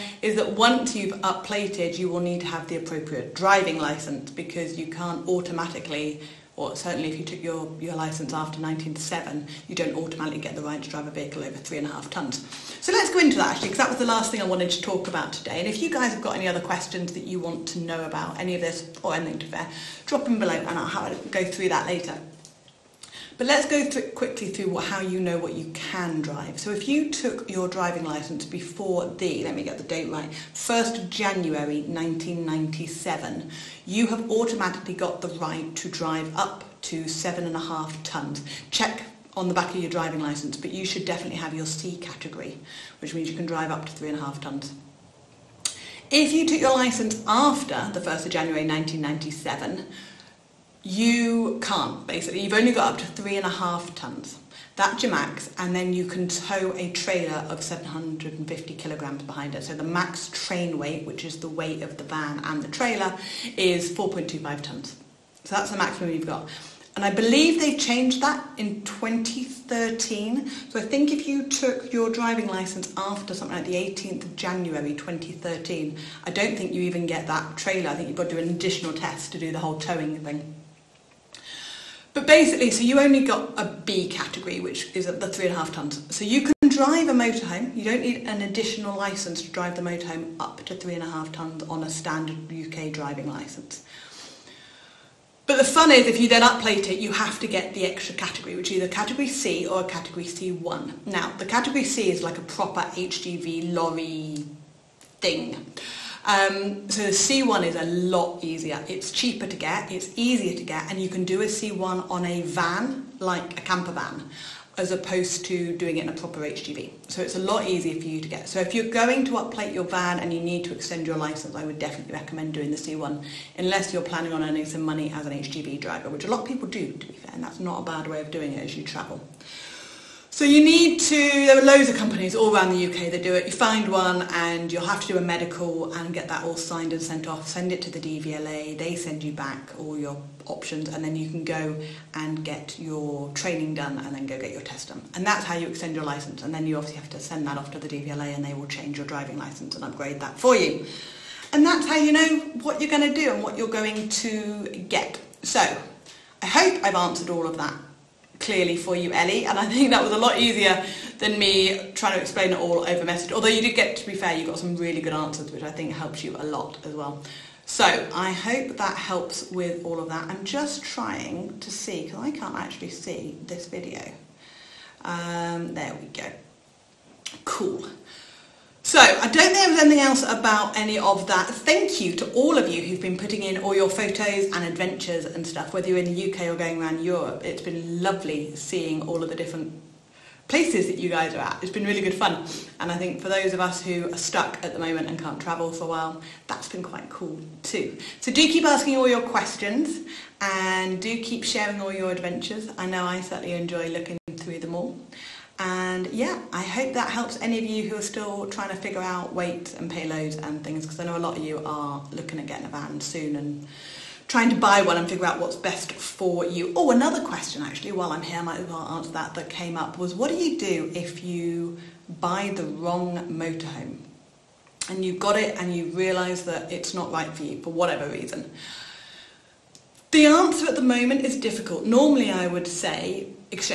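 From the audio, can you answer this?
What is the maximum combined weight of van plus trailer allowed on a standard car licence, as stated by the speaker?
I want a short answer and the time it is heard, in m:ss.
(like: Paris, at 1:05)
4.25 tons, at 1:03.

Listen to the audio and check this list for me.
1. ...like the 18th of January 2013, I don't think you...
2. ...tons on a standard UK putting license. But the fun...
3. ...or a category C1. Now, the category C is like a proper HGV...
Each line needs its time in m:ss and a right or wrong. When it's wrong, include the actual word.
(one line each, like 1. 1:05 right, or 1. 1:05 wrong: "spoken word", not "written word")
1. 1:13 right
2. 1:31 wrong: "driving", not "putting"
3. 1:39 right.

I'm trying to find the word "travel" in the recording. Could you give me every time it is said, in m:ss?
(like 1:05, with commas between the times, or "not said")
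2:08, 3:15.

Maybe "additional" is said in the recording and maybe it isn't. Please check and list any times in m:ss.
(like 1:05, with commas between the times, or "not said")
1:18, 1:28.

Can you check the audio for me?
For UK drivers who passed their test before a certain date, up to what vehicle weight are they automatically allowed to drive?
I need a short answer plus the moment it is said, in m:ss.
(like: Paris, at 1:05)
7.5 tons, at 0:37.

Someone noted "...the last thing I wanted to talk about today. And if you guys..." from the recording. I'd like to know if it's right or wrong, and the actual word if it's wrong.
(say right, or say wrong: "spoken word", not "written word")
right.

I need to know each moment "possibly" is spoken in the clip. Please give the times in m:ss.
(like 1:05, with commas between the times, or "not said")
not said.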